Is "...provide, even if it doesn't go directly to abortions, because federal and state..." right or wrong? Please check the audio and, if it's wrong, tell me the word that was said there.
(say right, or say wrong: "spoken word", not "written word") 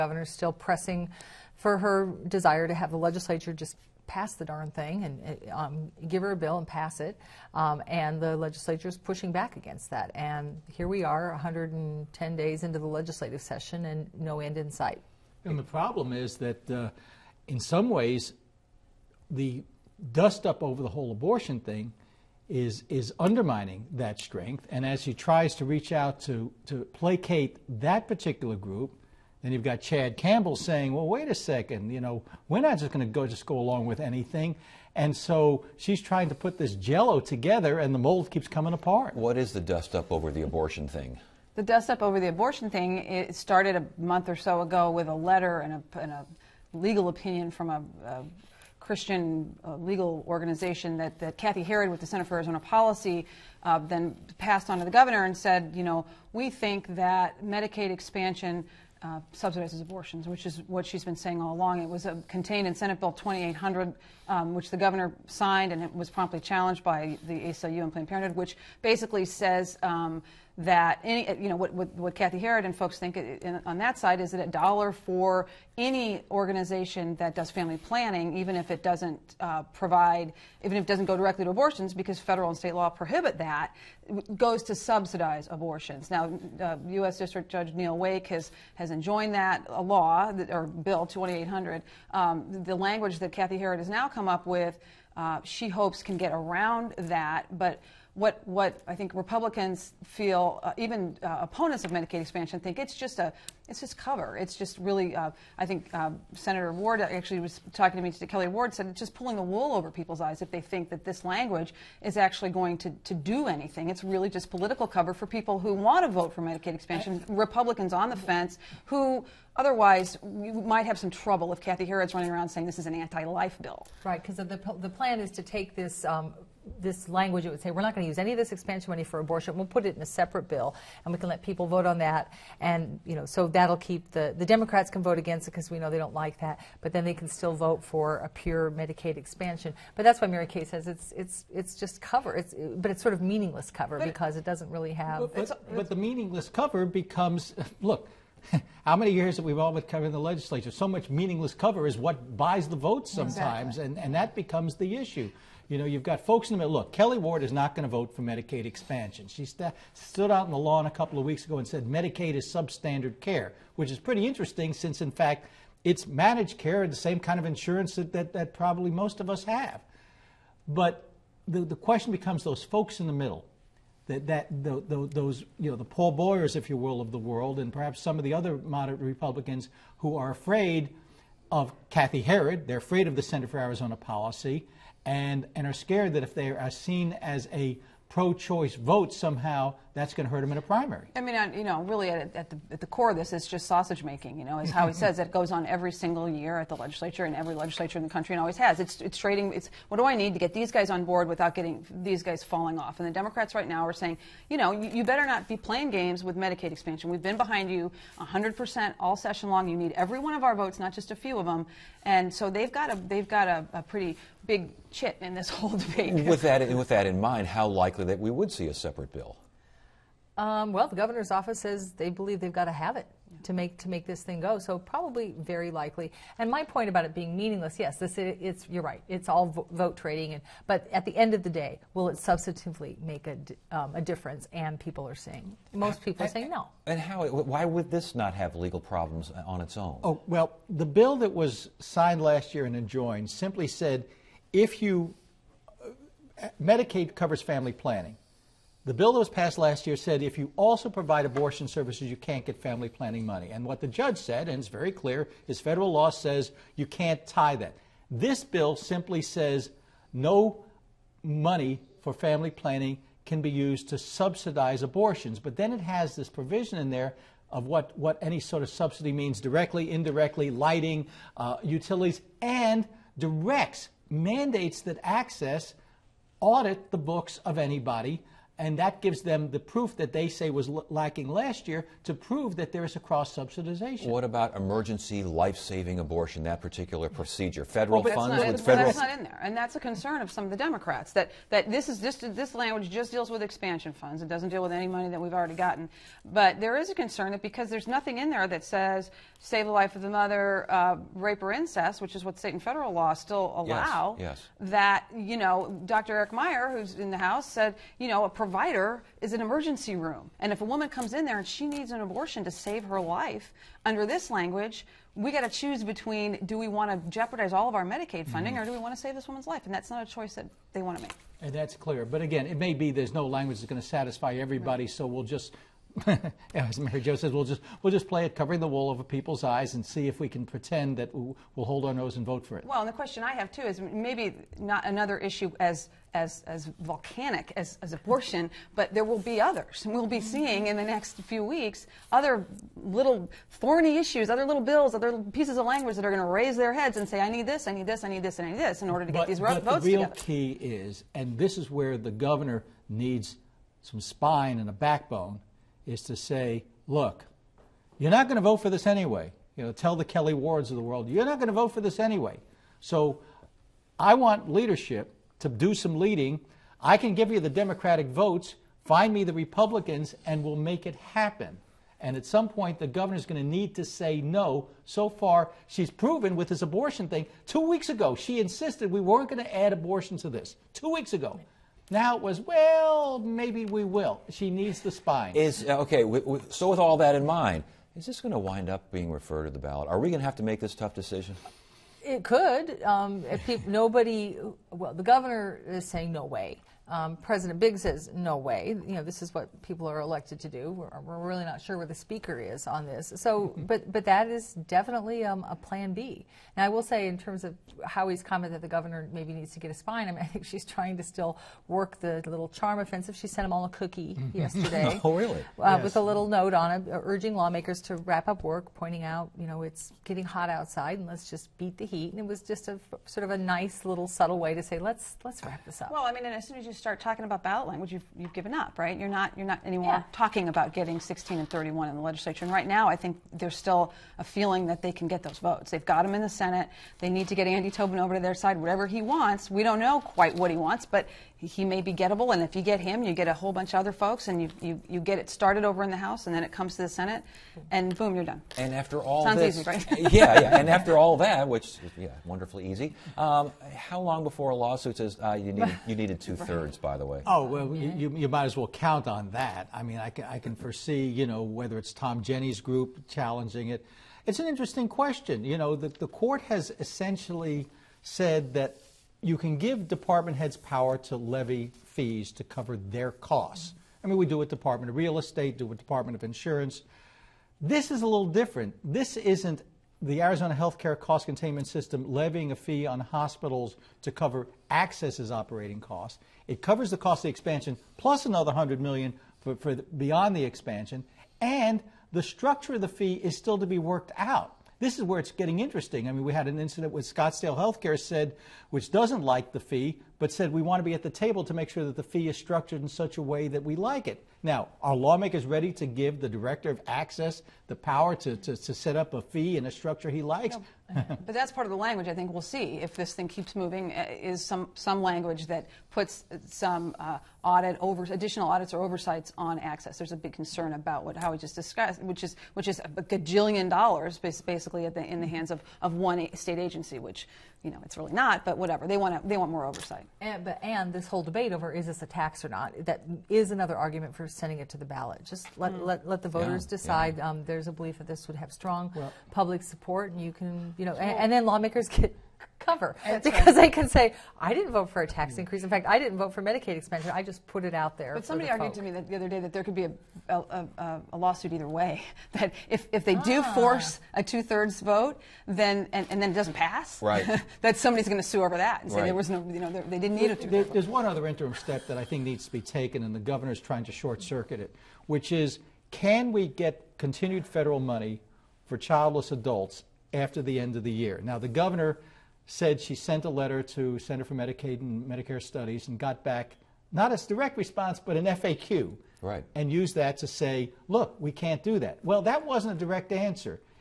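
right.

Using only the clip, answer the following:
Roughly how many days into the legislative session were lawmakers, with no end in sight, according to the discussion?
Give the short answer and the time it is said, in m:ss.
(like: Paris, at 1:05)
110, at 0:11.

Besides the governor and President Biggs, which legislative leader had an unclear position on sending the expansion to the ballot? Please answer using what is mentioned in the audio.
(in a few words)
The speaker.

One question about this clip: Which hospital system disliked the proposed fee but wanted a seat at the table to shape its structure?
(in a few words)
Scottsdale Healthcare.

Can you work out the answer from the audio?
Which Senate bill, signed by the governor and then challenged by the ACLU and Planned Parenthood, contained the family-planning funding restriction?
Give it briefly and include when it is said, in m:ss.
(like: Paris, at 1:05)
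Senate Bill 2800, at 1:02.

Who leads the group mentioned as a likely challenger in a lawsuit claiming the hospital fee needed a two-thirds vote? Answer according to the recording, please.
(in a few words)
Tom Jenney.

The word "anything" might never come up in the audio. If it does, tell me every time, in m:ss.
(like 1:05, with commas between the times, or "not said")
0:33, 1:53.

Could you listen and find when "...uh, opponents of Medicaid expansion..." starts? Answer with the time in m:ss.
1:41.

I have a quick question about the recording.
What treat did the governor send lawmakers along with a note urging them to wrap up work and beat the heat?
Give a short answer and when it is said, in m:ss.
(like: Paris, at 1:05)
A cookie, at 6:53.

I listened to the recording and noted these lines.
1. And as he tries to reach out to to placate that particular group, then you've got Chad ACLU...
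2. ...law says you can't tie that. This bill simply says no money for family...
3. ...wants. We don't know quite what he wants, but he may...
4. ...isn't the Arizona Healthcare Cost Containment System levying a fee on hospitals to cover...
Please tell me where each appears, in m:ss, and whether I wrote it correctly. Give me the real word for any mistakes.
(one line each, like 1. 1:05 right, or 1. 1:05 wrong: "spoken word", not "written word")
1. 0:24 wrong: "Campbell", not "ACLU"
2. 4:15 right
3. 7:19 right
4. 7:59 right.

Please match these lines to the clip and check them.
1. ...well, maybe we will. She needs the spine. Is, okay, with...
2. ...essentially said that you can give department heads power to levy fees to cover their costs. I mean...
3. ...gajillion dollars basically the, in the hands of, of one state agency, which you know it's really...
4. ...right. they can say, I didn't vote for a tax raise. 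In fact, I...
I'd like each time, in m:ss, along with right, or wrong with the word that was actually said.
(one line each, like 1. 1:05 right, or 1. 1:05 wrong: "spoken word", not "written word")
1. 6:22 right
2. 7:46 right
3. 8:43 right
4. 9:03 wrong: "increase", not "raise".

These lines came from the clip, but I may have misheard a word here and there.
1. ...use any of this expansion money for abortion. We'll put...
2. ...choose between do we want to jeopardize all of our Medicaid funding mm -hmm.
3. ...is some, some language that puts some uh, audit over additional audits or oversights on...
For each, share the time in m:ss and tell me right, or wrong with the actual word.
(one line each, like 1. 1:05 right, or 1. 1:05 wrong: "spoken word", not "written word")
1. 2:08 right
2. 5:15 right
3. 8:34 right.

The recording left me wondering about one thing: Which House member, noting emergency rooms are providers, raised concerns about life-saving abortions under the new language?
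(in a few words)
Eric Meyer.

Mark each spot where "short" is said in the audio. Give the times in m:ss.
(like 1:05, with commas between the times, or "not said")
9:23.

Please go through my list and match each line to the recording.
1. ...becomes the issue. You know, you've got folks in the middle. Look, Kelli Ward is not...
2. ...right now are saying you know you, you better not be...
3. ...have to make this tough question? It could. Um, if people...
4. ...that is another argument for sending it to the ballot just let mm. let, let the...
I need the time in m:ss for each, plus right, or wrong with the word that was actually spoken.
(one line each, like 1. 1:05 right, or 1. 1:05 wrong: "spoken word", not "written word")
1. 2:34 right
2. 3:23 right
3. 6:30 wrong: "decision", not "question"
4. 8:52 right.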